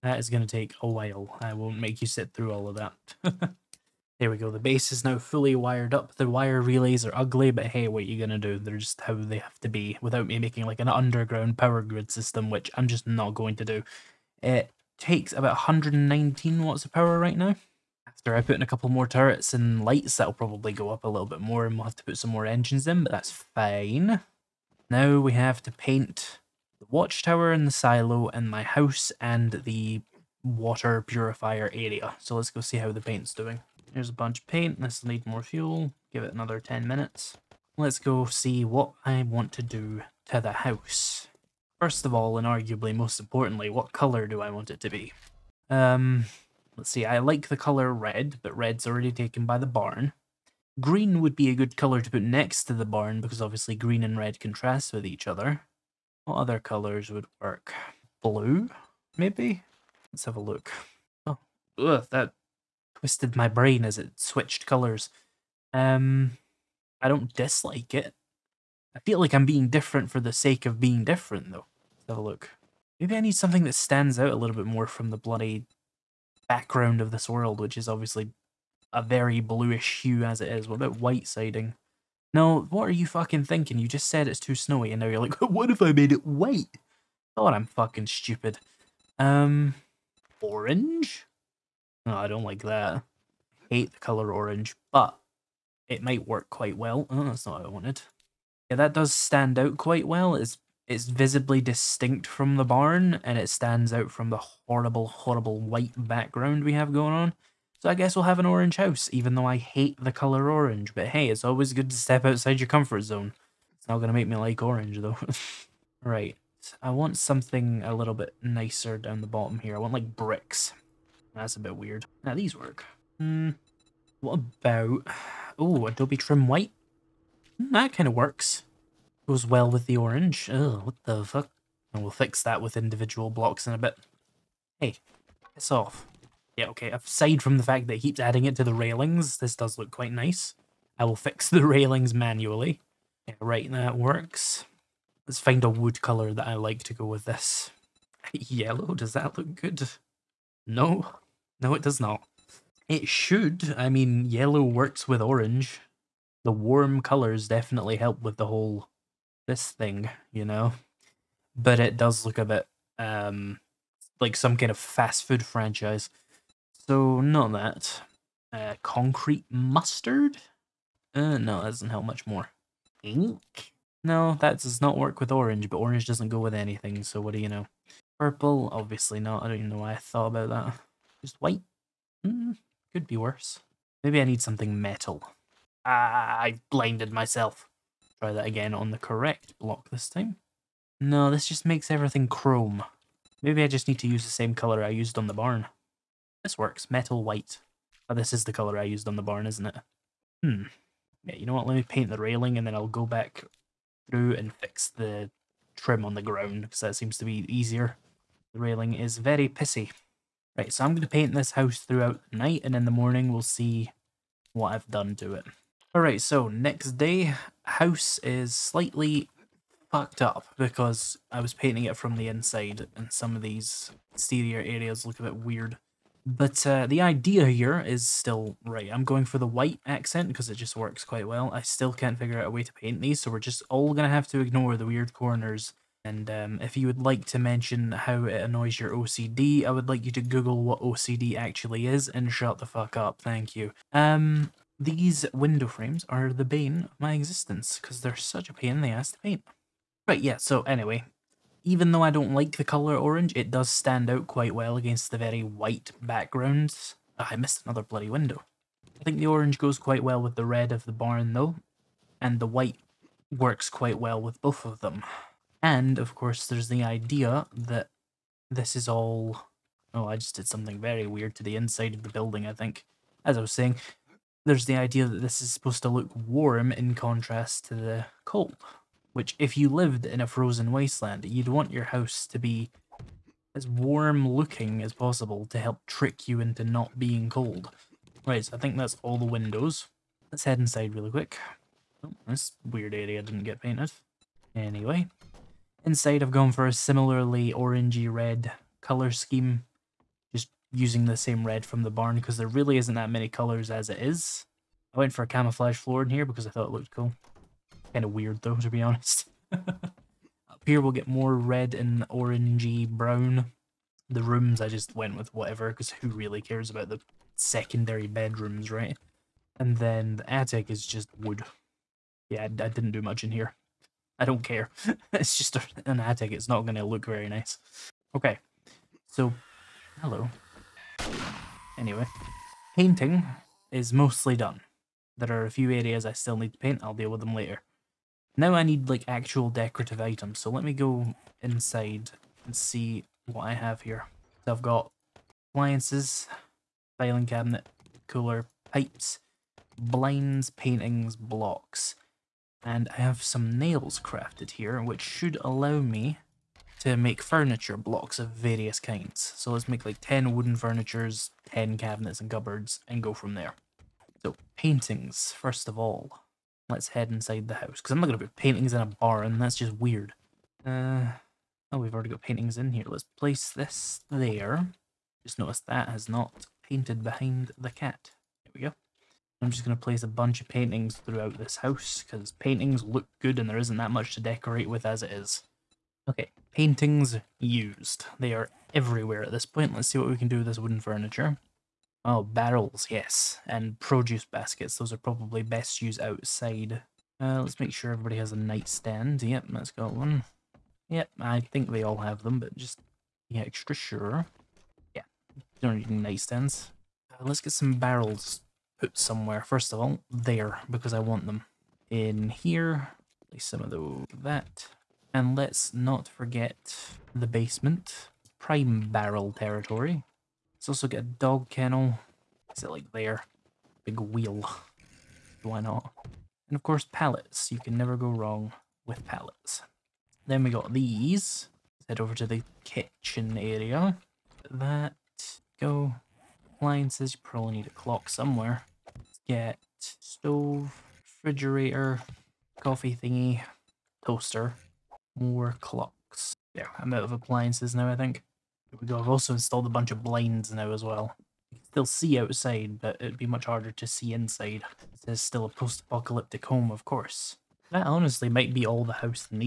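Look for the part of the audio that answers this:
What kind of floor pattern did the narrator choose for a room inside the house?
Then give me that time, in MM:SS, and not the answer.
05:05.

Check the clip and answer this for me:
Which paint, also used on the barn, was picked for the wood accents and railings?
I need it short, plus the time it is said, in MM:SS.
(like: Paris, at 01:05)
Metal white, at 03:16.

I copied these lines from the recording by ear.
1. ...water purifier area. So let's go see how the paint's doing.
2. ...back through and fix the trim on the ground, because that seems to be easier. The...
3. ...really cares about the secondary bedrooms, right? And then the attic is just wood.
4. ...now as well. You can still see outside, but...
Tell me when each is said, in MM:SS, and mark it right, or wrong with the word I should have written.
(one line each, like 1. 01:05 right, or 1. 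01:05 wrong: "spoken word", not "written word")
1. 00:30 right
2. 03:23 right
3. 05:16 right
4. 07:30 right.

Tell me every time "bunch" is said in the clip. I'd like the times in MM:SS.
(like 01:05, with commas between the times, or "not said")
00:34, 06:20, 07:29.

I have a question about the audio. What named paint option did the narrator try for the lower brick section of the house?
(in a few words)
Adobe Trim White.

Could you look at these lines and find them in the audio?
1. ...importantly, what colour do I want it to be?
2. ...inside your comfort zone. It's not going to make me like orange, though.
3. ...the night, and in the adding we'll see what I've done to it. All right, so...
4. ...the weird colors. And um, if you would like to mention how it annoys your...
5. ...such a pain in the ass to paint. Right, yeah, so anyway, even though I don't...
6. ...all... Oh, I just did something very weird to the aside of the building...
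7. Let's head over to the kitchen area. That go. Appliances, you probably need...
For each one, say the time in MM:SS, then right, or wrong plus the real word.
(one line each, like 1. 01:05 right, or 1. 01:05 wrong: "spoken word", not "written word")
1. 00:43 right
2. 01:52 wrong: "outside", not "inside"
3. 03:32 wrong: "morning", not "adding"
4. 03:54 wrong: "corners", not "colors"
5. 04:08 right
6. 04:28 wrong: "inside", not "aside"
7. 07:11 right.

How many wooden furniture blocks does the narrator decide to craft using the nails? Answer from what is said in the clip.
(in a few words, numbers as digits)
10.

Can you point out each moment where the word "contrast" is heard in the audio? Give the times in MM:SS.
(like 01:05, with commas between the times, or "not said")
00:54, 04:36.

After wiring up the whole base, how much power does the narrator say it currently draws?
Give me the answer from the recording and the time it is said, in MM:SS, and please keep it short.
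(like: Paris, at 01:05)
119 watts, at 00:15.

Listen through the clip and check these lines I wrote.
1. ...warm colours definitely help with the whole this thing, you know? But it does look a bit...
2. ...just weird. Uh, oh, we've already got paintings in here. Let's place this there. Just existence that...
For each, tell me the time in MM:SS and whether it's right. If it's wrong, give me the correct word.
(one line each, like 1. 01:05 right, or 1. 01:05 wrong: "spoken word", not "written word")
1. 02:36 right
2. 06:09 wrong: "notice", not "existence".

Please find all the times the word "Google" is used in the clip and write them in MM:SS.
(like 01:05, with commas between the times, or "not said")
04:00.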